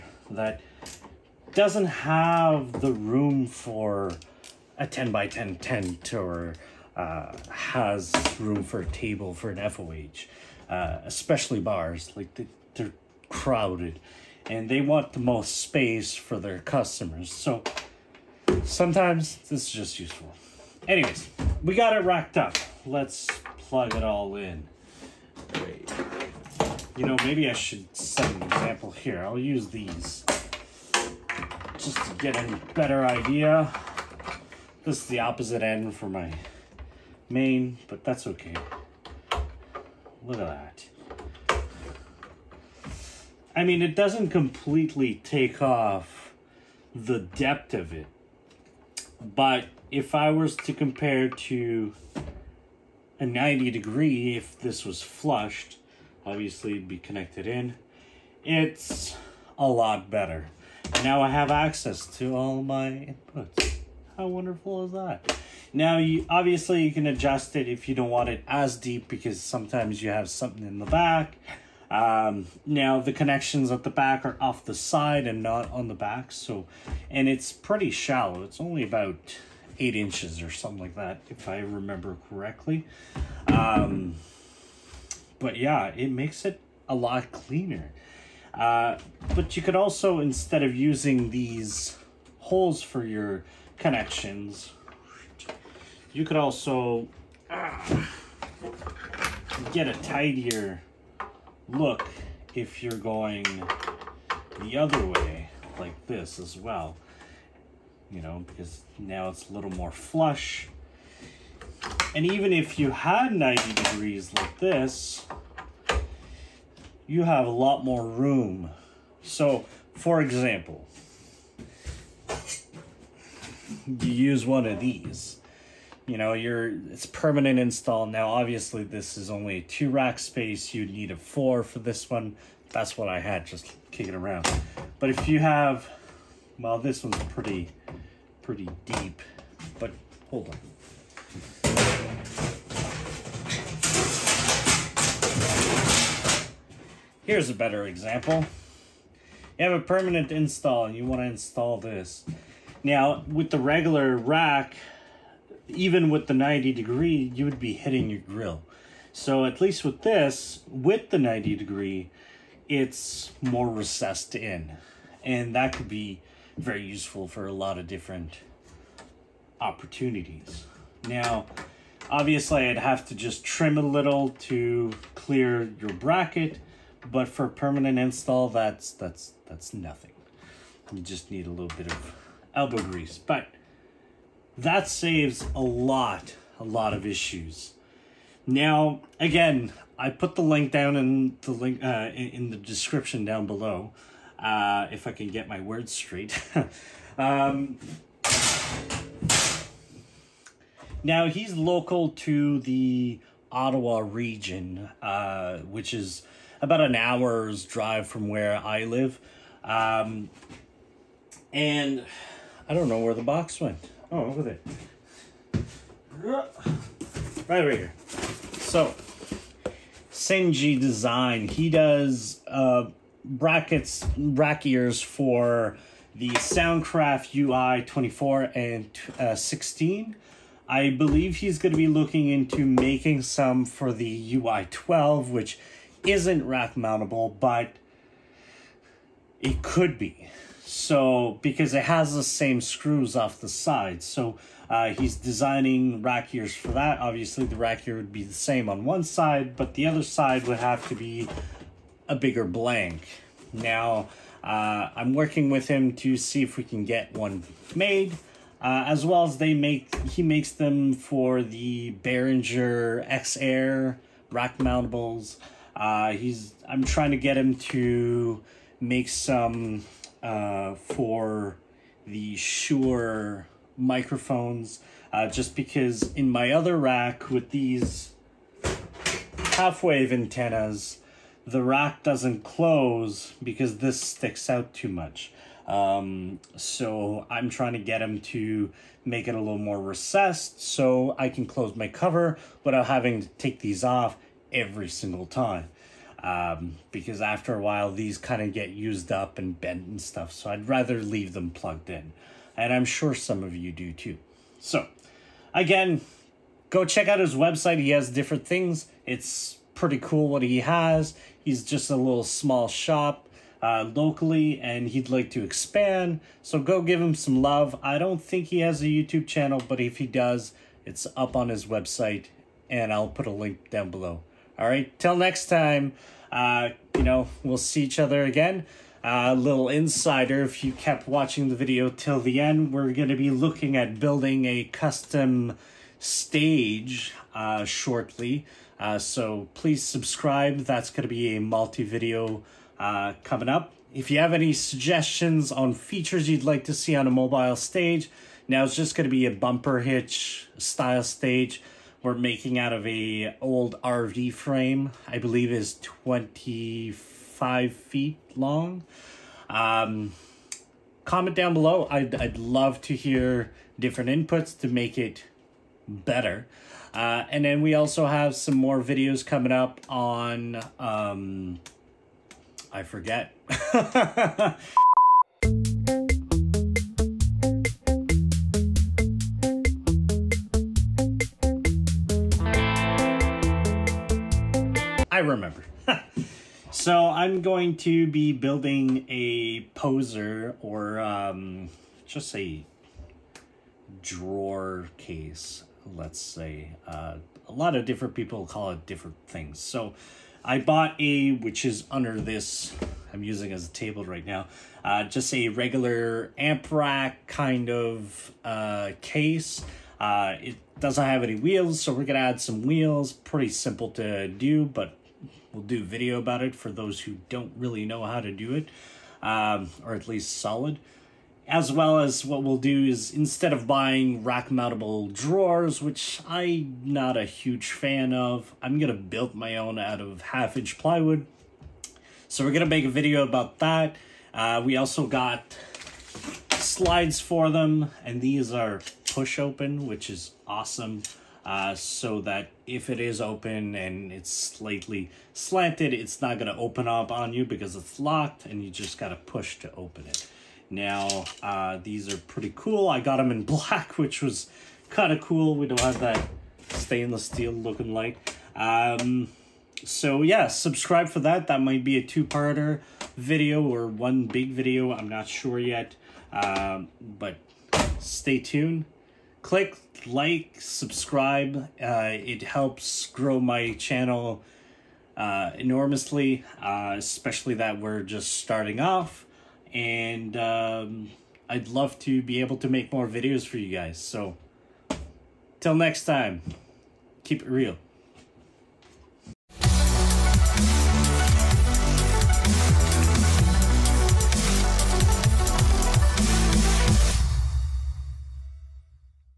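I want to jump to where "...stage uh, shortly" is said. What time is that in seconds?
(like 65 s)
335 s.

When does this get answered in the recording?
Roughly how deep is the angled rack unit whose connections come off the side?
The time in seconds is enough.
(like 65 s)
79 s.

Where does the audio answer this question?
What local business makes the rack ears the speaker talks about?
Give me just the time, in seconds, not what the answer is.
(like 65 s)
220 s.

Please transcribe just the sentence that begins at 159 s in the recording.
So at least with this, with the 90 degree, it's more recessed in.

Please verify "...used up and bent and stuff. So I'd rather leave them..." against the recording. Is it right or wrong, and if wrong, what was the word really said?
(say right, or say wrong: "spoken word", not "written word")
right.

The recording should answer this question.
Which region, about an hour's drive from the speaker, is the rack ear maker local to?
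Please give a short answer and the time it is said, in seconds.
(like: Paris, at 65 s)
Ottawa, at 203 s.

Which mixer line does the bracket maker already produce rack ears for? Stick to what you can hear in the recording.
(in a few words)
Behringer X Air.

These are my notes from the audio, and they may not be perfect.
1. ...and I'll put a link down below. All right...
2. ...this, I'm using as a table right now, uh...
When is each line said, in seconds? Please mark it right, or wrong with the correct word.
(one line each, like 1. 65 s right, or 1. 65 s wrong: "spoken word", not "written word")
1. 322 s right
2. 402 s right.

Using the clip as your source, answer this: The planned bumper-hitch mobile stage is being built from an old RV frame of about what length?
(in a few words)
25 feet.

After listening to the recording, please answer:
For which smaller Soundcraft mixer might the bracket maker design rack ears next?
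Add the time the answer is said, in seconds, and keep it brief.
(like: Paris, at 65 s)
UI 12, at 234 s.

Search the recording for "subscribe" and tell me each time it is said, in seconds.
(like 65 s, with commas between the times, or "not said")
339 s, 460 s, 470 s.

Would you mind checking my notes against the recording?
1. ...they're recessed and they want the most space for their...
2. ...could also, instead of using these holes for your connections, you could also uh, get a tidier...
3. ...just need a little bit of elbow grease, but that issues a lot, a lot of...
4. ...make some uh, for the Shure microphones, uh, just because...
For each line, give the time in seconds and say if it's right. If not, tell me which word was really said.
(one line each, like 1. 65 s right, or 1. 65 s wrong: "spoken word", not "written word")
1. 12 s wrong: "crowded", not "recessed"
2. 89 s right
3. 181 s wrong: "saves", not "issues"
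4. 268 s right.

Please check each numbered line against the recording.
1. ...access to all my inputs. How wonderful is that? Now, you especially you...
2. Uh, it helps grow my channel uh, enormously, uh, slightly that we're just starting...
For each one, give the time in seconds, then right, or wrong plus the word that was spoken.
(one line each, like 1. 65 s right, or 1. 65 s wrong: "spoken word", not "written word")
1. 61 s wrong: "obviously", not "especially"
2. 471 s wrong: "especially", not "slightly".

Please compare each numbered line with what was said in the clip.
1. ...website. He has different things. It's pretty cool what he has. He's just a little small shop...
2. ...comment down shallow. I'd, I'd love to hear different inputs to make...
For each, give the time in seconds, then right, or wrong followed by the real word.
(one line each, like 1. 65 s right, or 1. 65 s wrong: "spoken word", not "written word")
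1. 307 s right
2. 361 s wrong: "below", not "shallow".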